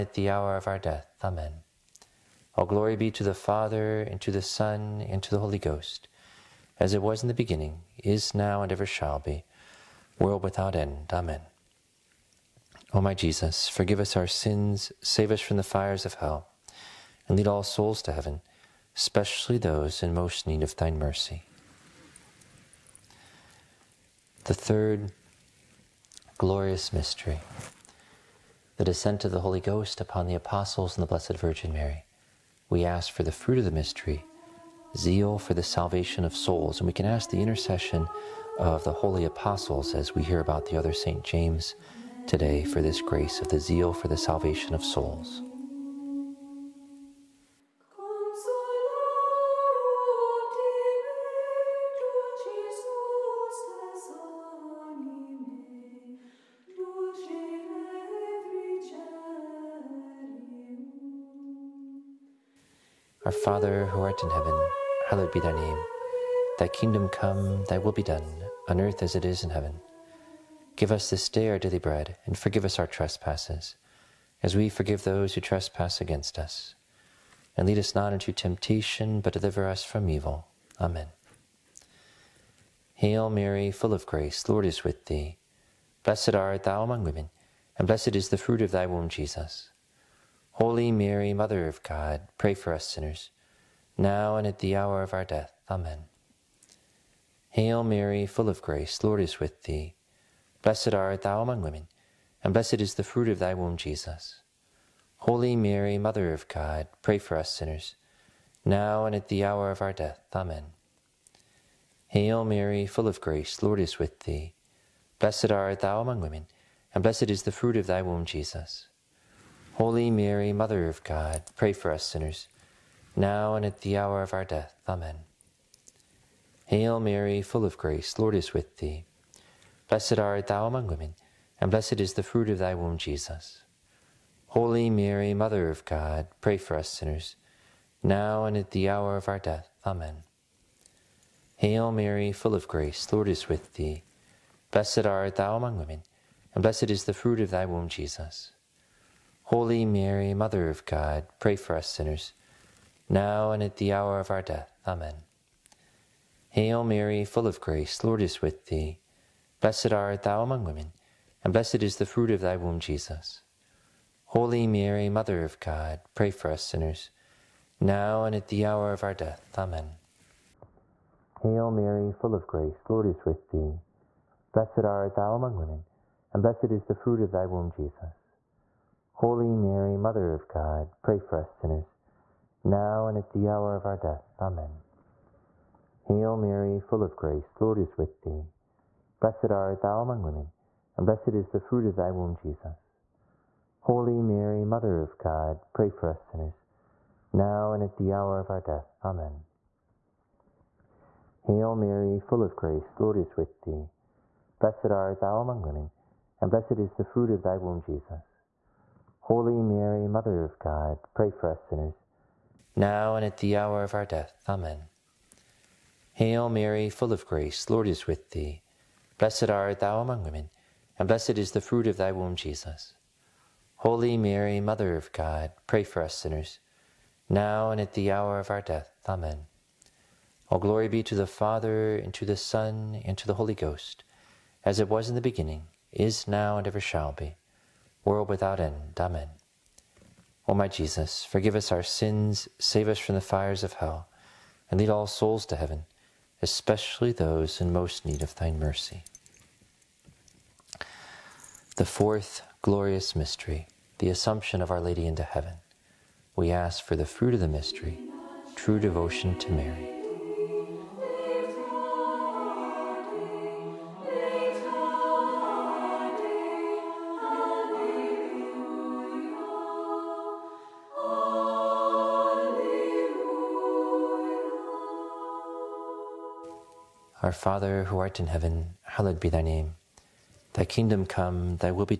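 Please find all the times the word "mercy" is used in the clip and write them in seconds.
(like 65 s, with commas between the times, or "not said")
20 s, 248 s.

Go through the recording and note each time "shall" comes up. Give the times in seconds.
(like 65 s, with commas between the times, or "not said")
8 s, 236 s.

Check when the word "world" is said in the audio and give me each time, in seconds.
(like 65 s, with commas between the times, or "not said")
10 s, 238 s.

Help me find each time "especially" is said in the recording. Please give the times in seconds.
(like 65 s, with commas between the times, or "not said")
18 s, 246 s.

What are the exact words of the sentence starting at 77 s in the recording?
And lead us not into temptation, but deliver us from evil.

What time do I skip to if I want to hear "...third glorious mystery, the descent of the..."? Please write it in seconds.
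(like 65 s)
24 s.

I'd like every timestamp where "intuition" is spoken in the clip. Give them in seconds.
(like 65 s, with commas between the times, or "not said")
not said.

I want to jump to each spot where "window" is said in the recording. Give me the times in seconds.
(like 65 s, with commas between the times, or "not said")
not said.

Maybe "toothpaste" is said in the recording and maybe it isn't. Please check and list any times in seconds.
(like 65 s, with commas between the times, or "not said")
not said.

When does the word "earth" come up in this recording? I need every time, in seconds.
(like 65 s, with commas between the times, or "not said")
68 s.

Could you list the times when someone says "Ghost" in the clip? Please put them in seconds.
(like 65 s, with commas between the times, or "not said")
5 s, 29 s, 233 s.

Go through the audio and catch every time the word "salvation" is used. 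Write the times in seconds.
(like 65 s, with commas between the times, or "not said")
35 s, 44 s.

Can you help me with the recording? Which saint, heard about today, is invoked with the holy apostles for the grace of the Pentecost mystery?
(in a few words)
St. James.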